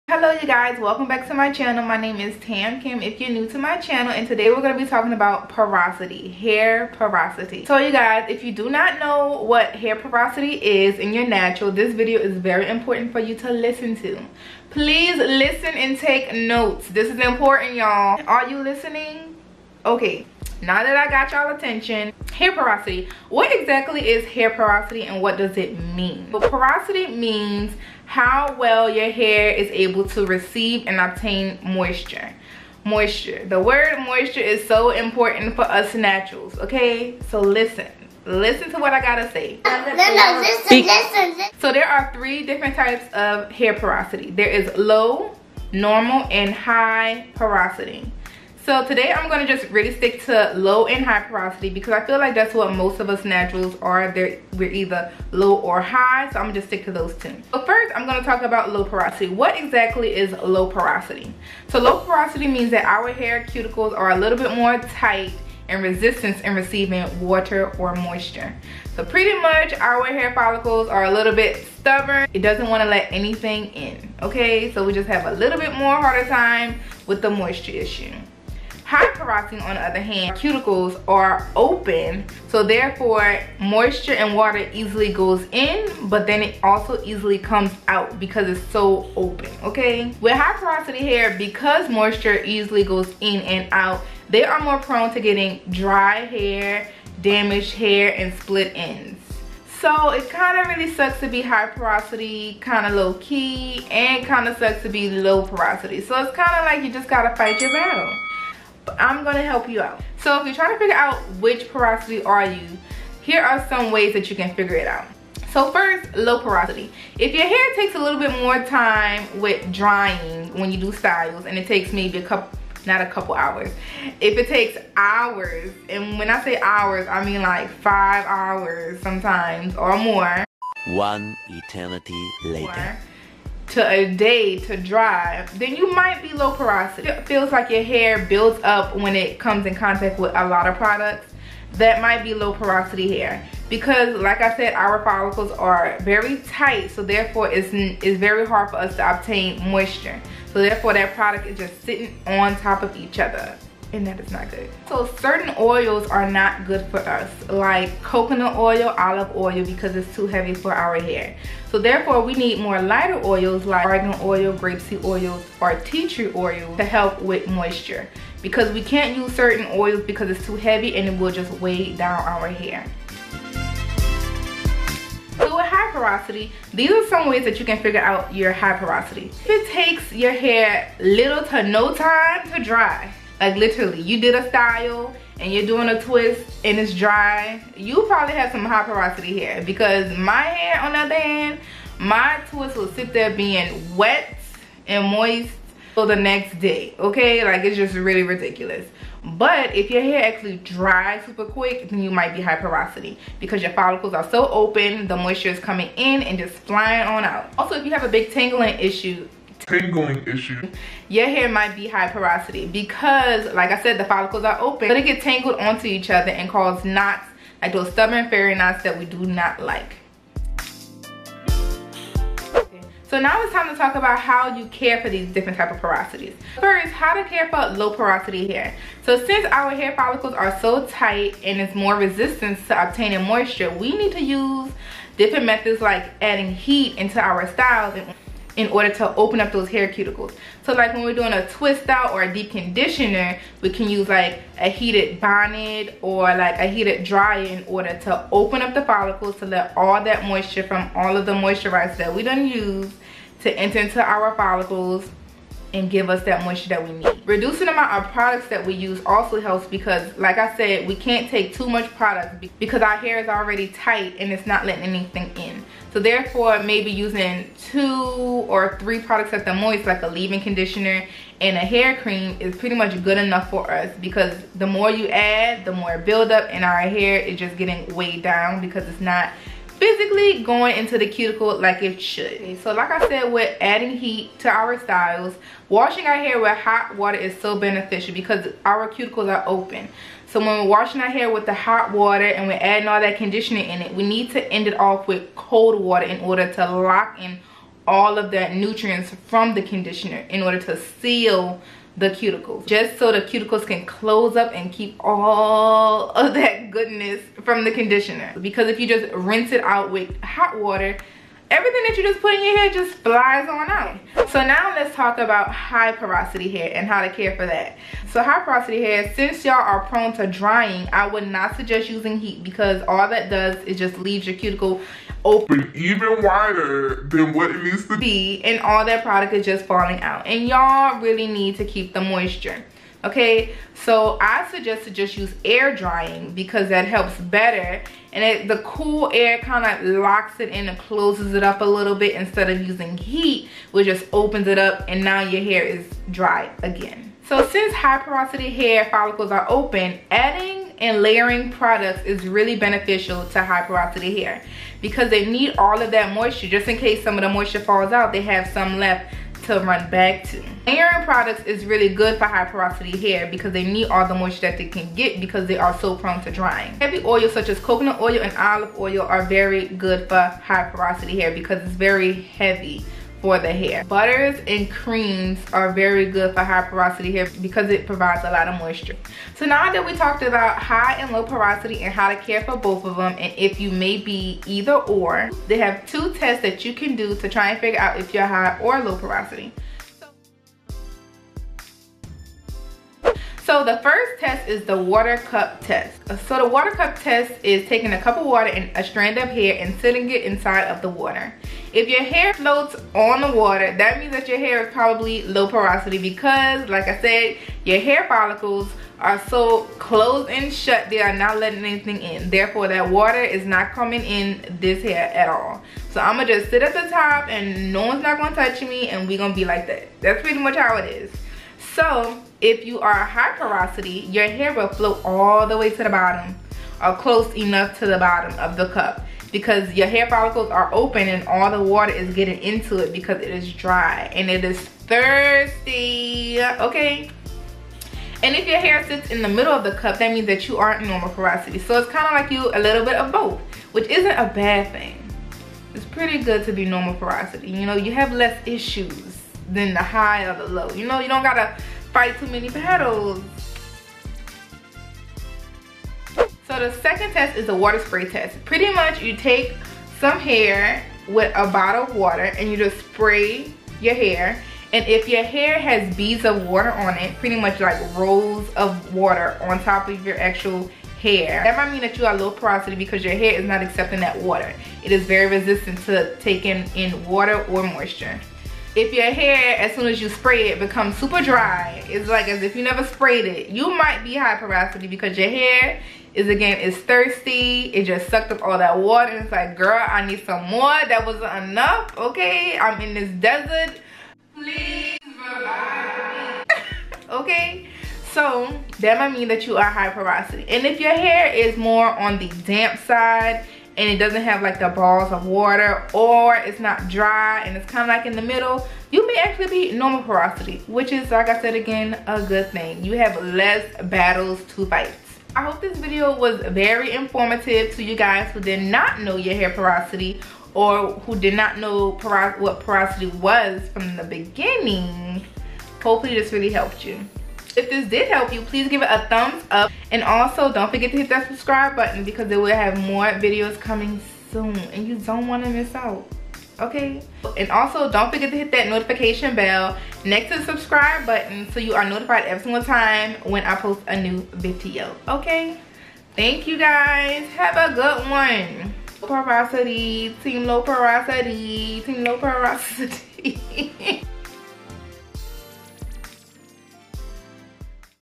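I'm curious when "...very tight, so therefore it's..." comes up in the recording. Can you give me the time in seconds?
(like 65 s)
146 s.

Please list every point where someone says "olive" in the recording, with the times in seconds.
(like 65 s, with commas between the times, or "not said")
158 s, 368 s.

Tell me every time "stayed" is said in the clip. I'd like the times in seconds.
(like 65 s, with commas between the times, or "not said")
not said.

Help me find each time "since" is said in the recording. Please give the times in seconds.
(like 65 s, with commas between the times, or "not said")
229 s, 319 s, 347 s.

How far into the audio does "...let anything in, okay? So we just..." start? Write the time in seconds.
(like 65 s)
72 s.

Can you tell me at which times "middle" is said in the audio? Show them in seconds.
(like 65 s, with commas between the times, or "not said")
439 s, 508 s.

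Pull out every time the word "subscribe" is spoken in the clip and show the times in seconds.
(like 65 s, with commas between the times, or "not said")
531 s, 540 s.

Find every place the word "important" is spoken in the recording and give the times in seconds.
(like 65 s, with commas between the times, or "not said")
12 s, 17 s, 34 s.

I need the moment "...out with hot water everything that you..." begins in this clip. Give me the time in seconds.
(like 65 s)
309 s.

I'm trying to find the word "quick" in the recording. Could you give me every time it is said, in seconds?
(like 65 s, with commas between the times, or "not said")
201 s.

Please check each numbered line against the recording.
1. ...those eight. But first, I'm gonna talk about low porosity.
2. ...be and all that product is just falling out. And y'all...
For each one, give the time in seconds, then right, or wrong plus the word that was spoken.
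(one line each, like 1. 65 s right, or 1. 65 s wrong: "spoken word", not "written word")
1. 56 s wrong: "two", not "eight"
2. 327 s right.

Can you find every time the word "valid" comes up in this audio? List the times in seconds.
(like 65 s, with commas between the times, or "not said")
not said.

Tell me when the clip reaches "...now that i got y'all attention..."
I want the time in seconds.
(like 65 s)
20 s.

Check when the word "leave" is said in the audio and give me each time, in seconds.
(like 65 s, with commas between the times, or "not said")
270 s, 323 s.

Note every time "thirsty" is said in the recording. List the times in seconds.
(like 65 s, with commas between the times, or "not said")
434 s, 486 s.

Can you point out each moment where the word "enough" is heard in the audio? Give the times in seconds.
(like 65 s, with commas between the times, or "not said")
273 s, 427 s, 491 s.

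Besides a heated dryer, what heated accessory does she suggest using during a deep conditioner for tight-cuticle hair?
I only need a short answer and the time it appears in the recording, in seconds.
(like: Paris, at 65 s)
Heated bonnet, at 244 s.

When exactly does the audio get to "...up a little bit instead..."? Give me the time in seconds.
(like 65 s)
341 s.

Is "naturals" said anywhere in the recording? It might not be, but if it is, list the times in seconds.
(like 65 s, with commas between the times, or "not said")
11 s, 35 s, 53 s.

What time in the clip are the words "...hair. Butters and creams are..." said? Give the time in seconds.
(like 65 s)
373 s.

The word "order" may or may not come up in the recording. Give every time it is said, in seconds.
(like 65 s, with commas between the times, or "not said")
238 s, 247 s, 296 s, 300 s.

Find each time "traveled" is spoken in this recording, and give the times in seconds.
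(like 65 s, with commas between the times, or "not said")
not said.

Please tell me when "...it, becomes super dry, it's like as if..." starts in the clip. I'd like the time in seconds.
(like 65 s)
480 s.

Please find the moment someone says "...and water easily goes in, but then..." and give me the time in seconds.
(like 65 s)
84 s.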